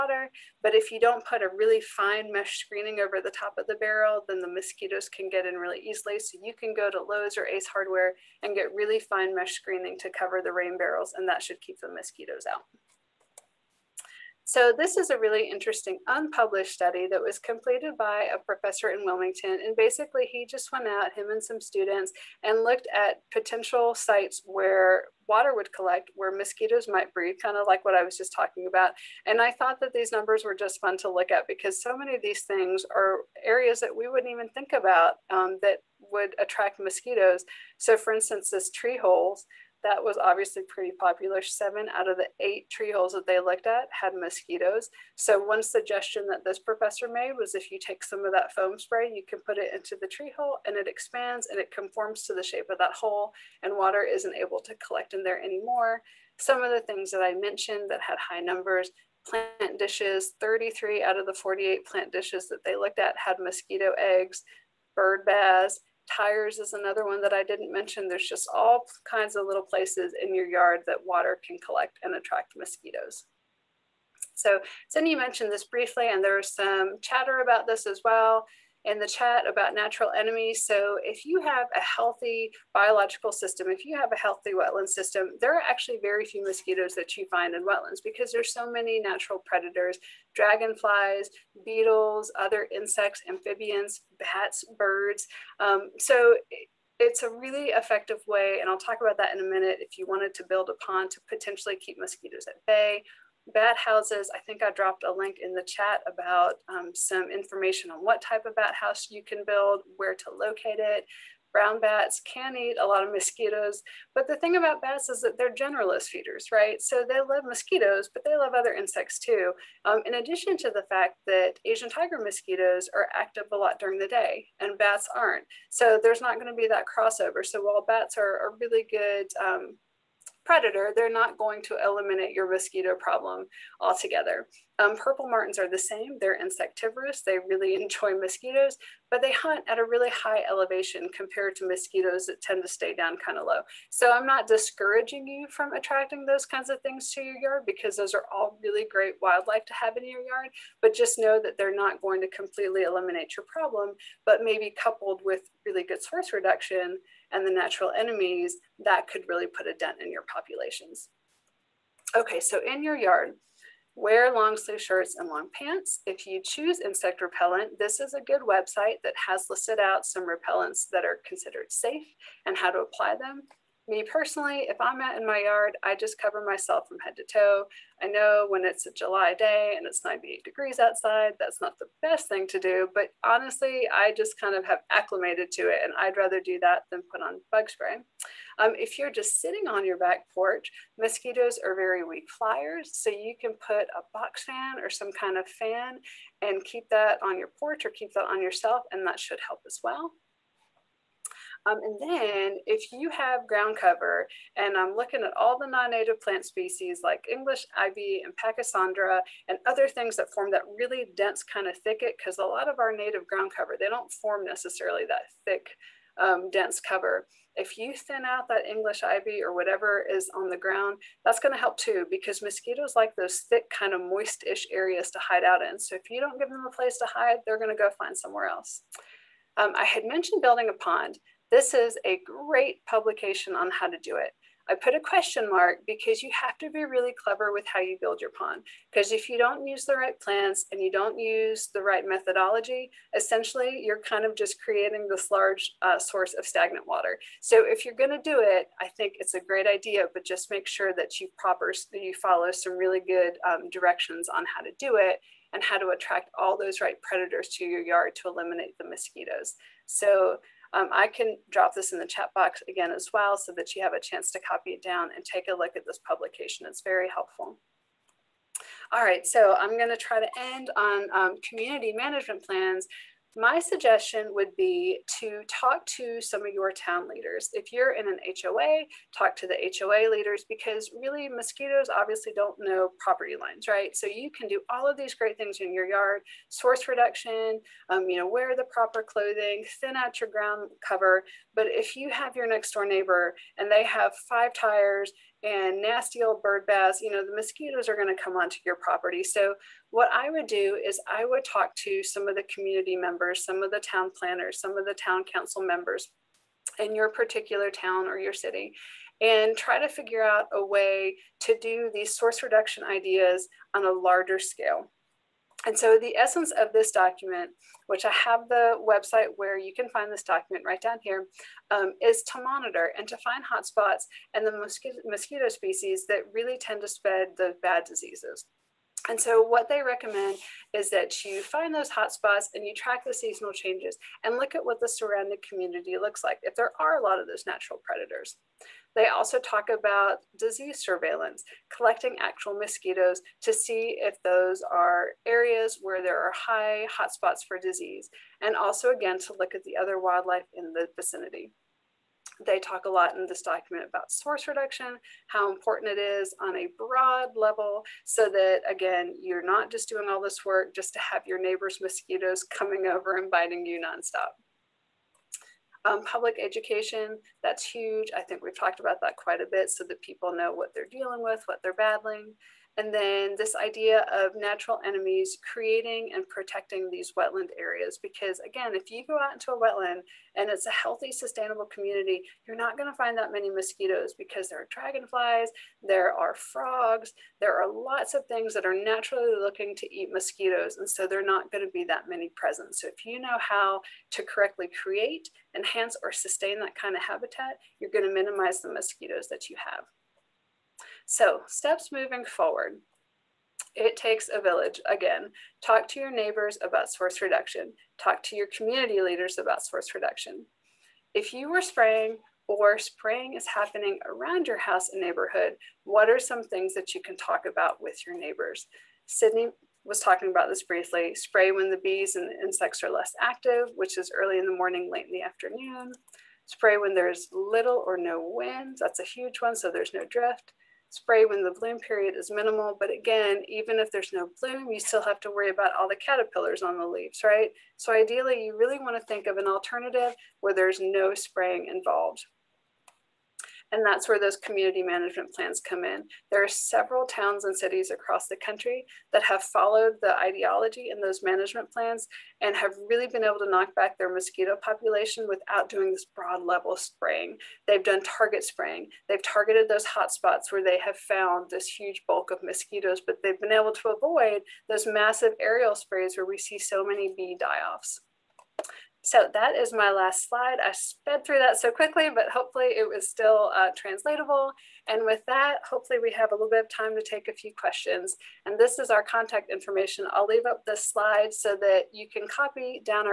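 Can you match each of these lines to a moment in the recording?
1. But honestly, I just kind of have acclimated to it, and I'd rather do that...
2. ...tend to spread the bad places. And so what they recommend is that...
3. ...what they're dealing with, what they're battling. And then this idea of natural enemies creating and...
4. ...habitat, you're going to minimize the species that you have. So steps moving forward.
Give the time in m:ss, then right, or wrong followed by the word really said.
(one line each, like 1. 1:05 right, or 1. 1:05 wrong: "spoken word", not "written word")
1. 3:02 right
2. 5:26 wrong: "diseases", not "places"
3. 6:10 right
4. 6:37 wrong: "mosquitoes", not "species".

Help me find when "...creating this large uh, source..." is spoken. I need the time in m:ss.
4:04.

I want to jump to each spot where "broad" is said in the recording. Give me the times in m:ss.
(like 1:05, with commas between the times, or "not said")
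5:56, 7:36.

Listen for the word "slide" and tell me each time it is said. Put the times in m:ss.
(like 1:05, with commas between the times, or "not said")
7:50, 8:00.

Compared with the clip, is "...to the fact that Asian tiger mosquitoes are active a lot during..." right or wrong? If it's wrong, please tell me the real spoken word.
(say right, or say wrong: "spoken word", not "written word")
right.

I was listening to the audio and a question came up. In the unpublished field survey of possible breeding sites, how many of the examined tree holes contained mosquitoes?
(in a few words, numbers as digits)
7.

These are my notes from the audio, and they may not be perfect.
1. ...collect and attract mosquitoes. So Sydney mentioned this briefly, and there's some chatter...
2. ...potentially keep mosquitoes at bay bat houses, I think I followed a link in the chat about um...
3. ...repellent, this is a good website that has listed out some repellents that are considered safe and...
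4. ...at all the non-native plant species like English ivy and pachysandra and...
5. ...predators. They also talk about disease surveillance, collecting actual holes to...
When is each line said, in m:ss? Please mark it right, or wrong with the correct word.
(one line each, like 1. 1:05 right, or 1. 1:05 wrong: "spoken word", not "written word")
1. 1:11 right
2. 1:41 wrong: "dropped", not "followed"
3. 2:47 right
4. 3:25 right
5. 5:37 wrong: "mosquitoes", not "holes".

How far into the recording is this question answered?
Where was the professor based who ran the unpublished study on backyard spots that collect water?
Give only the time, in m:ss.
0:19.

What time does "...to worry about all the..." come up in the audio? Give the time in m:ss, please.
7:15.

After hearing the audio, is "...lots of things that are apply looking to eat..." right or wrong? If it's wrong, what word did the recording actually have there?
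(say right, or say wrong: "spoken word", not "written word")
wrong: "naturally", not "apply".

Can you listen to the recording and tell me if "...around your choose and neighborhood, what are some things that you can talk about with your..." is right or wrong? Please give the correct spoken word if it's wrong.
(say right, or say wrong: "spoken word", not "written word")
wrong: "house", not "choose".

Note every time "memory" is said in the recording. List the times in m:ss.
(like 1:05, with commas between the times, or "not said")
not said.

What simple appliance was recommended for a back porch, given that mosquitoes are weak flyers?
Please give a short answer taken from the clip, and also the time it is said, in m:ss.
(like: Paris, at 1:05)
box fan, at 3:14.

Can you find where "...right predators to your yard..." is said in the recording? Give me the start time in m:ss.
4:16.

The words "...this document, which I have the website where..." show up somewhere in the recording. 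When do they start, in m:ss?
5:16.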